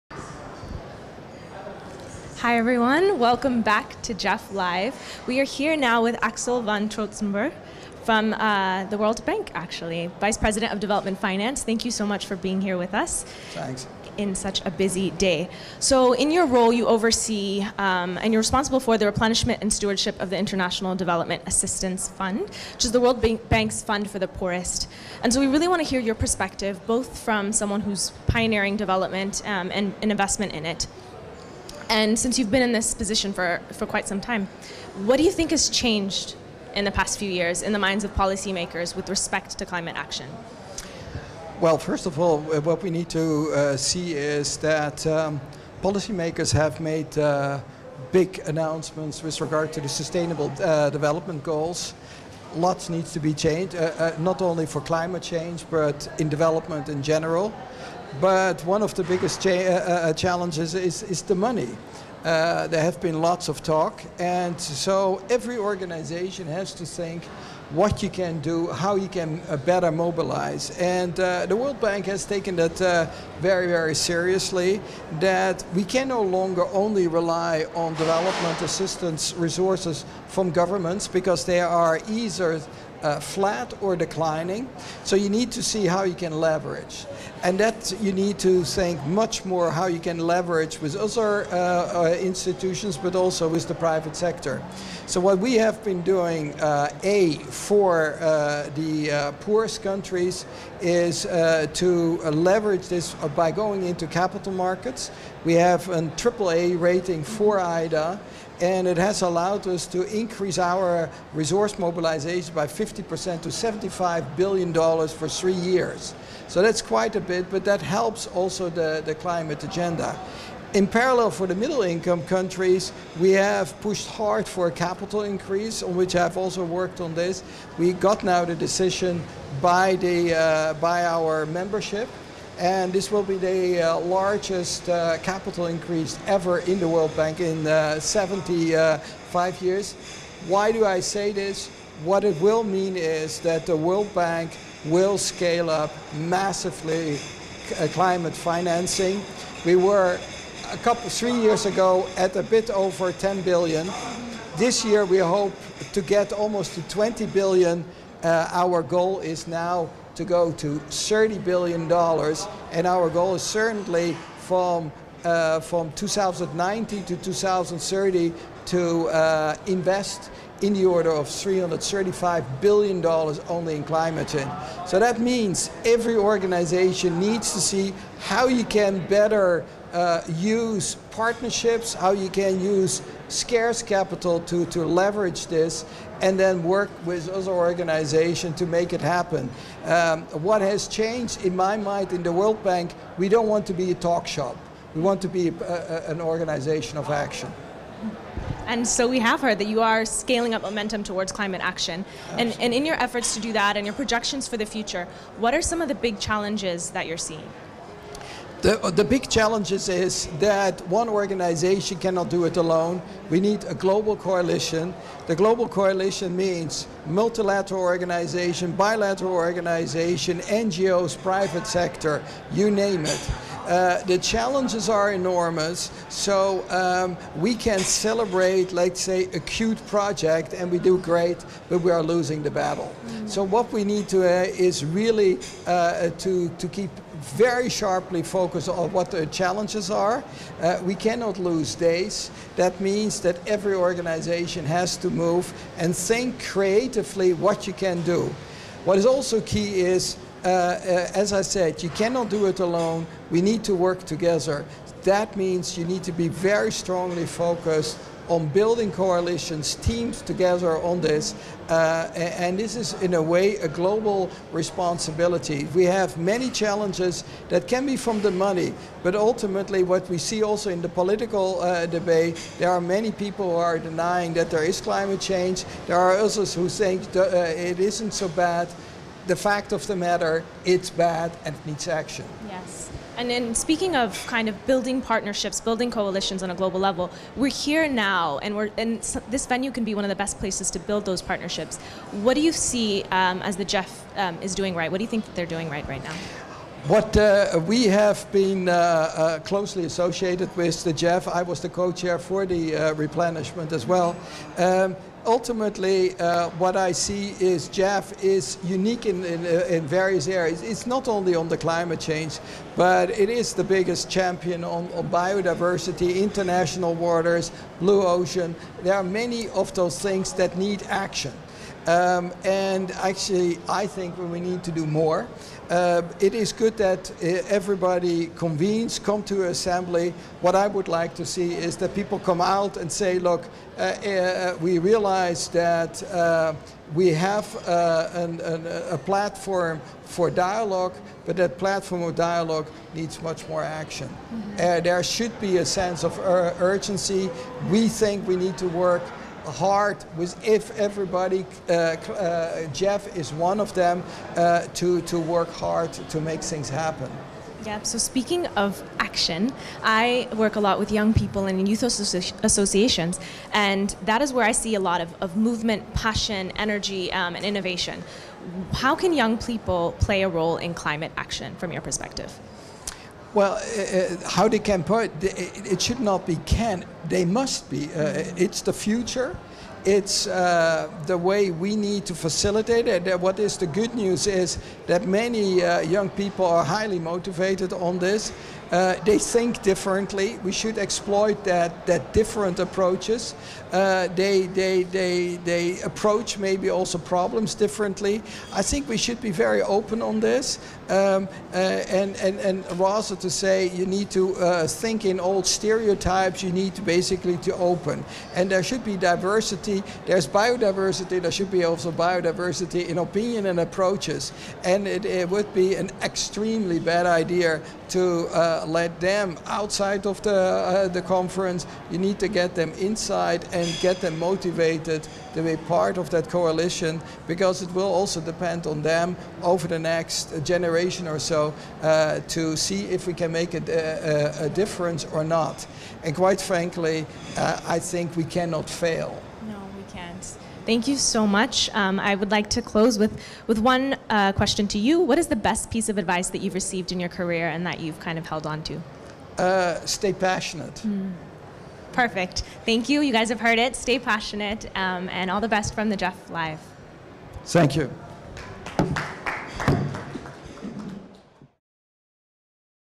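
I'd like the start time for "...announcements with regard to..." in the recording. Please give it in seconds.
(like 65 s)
48 s.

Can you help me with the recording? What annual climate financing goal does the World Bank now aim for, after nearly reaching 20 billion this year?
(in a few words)
$30 billion.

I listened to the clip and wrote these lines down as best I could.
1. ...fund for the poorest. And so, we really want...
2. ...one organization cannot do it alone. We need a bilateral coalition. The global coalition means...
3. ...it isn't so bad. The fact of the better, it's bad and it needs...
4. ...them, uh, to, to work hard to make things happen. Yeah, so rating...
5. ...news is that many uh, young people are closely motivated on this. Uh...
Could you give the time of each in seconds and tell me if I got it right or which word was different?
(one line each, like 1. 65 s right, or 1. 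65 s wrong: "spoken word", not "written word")
1. 23 s right
2. 210 s wrong: "global", not "bilateral"
3. 277 s wrong: "matter", not "better"
4. 353 s wrong: "speaking", not "rating"
5. 383 s wrong: "highly", not "closely".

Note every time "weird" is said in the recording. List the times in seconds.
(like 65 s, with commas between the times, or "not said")
not said.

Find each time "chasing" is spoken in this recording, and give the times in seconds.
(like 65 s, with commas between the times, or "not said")
not said.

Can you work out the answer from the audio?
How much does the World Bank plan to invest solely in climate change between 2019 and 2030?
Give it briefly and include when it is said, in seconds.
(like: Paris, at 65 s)
$335 billion, at 171 s.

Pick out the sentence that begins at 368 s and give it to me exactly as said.
How can young people play a role in climate action from your perspective?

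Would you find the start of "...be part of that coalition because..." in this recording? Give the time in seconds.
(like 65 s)
425 s.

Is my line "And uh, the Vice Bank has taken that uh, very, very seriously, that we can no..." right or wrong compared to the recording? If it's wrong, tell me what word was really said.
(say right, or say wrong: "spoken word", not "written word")
wrong: "World", not "Vice".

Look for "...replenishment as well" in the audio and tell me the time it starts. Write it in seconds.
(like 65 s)
302 s.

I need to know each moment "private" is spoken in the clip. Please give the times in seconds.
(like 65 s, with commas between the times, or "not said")
93 s, 221 s.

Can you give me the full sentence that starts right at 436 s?
And quite frankly, uh, I think we cannot fail.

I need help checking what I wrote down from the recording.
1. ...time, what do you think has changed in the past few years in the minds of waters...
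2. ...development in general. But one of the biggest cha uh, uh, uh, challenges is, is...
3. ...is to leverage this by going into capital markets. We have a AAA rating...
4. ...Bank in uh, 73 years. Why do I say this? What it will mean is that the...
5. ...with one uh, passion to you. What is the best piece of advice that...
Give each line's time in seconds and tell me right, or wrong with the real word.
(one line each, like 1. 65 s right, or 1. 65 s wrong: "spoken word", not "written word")
1. 34 s wrong: "policymakers", not "waters"
2. 56 s right
3. 100 s right
4. 137 s wrong: "75", not "73"
5. 443 s wrong: "question", not "passion".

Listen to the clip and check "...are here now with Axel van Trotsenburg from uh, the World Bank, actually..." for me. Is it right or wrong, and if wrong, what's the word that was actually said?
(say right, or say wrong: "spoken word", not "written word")
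right.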